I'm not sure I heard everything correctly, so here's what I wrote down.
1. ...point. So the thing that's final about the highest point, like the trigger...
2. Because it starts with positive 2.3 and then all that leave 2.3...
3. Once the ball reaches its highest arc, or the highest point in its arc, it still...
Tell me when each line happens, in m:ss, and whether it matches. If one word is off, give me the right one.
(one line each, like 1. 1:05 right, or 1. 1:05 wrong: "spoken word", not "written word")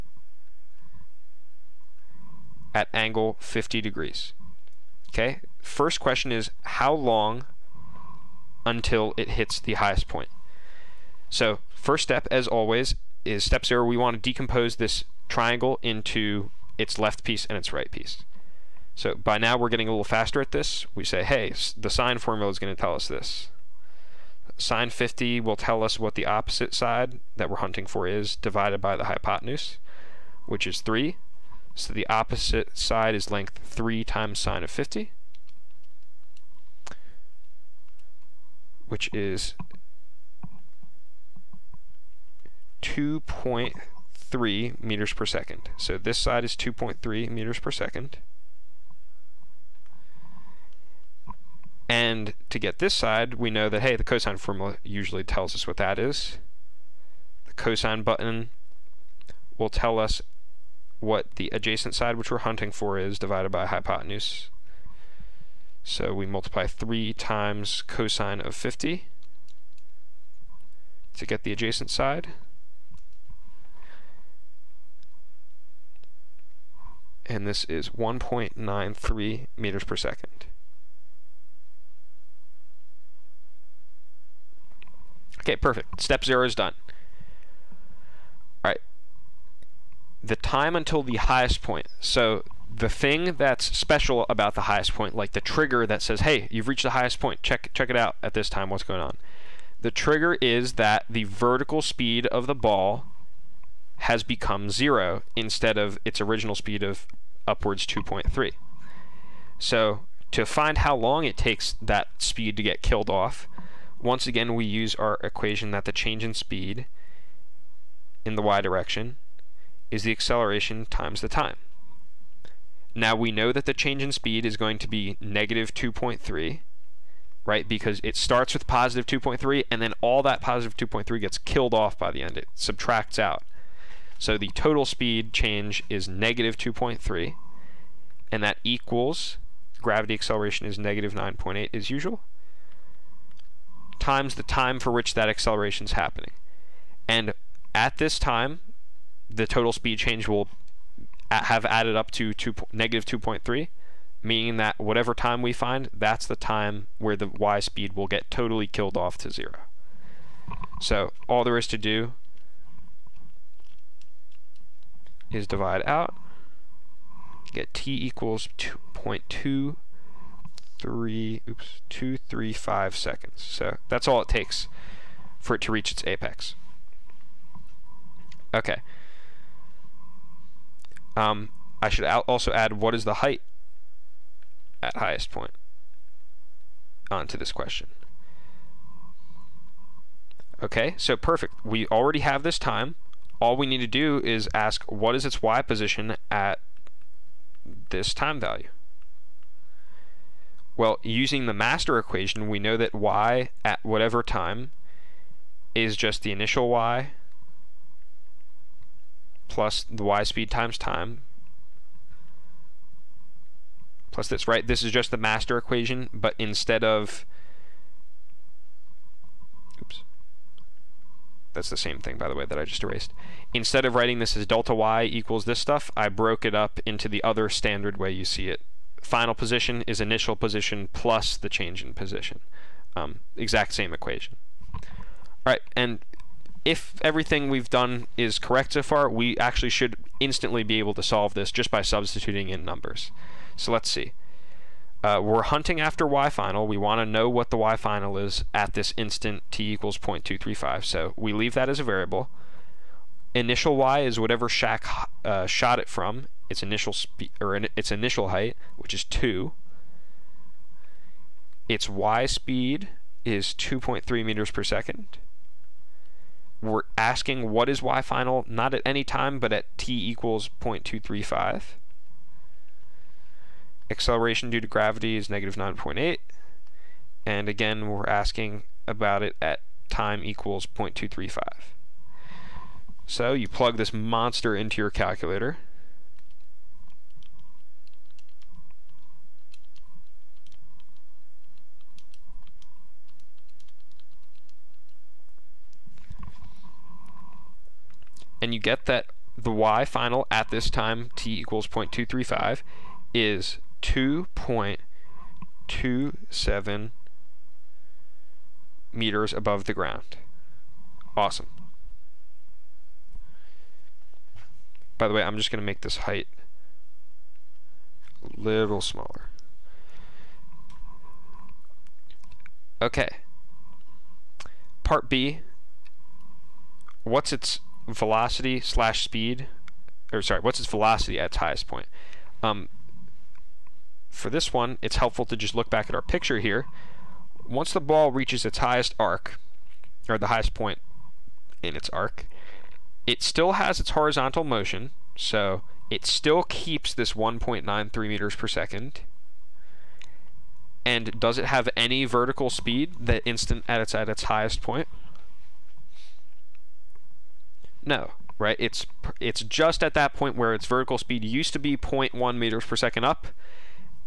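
1. 1:31 wrong: "special", not "final"
2. 2:07 wrong: "positive", not "leave"
3. 5:37 right.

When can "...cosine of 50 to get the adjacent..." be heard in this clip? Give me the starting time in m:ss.
1:07.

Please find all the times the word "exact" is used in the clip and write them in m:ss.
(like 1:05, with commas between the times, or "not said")
3:53.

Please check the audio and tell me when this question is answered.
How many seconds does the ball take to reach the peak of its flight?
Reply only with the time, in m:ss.
2:51.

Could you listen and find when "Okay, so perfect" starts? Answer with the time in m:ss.
3:10.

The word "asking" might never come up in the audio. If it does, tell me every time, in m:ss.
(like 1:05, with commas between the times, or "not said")
4:26, 4:38.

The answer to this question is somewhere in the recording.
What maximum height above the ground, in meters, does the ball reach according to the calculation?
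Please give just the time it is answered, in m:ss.
5:03.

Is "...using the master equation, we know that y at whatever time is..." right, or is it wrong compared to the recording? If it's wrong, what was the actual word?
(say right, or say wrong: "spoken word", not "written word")
right.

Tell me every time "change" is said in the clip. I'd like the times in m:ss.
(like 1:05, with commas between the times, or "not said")
1:55, 2:03, 2:15, 2:29, 3:51.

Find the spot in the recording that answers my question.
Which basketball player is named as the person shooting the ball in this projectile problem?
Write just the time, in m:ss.
4:14.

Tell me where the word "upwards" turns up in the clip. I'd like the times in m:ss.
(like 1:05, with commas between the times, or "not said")
1:47.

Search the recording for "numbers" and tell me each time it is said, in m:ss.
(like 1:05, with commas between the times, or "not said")
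4:02.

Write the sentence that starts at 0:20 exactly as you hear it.
We say, hey, the sine formula is going to tell us this.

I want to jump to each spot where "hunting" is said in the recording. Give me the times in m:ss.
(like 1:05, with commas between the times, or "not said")
0:27, 1:02, 4:05.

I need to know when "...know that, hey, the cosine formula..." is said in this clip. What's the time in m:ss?
0:53.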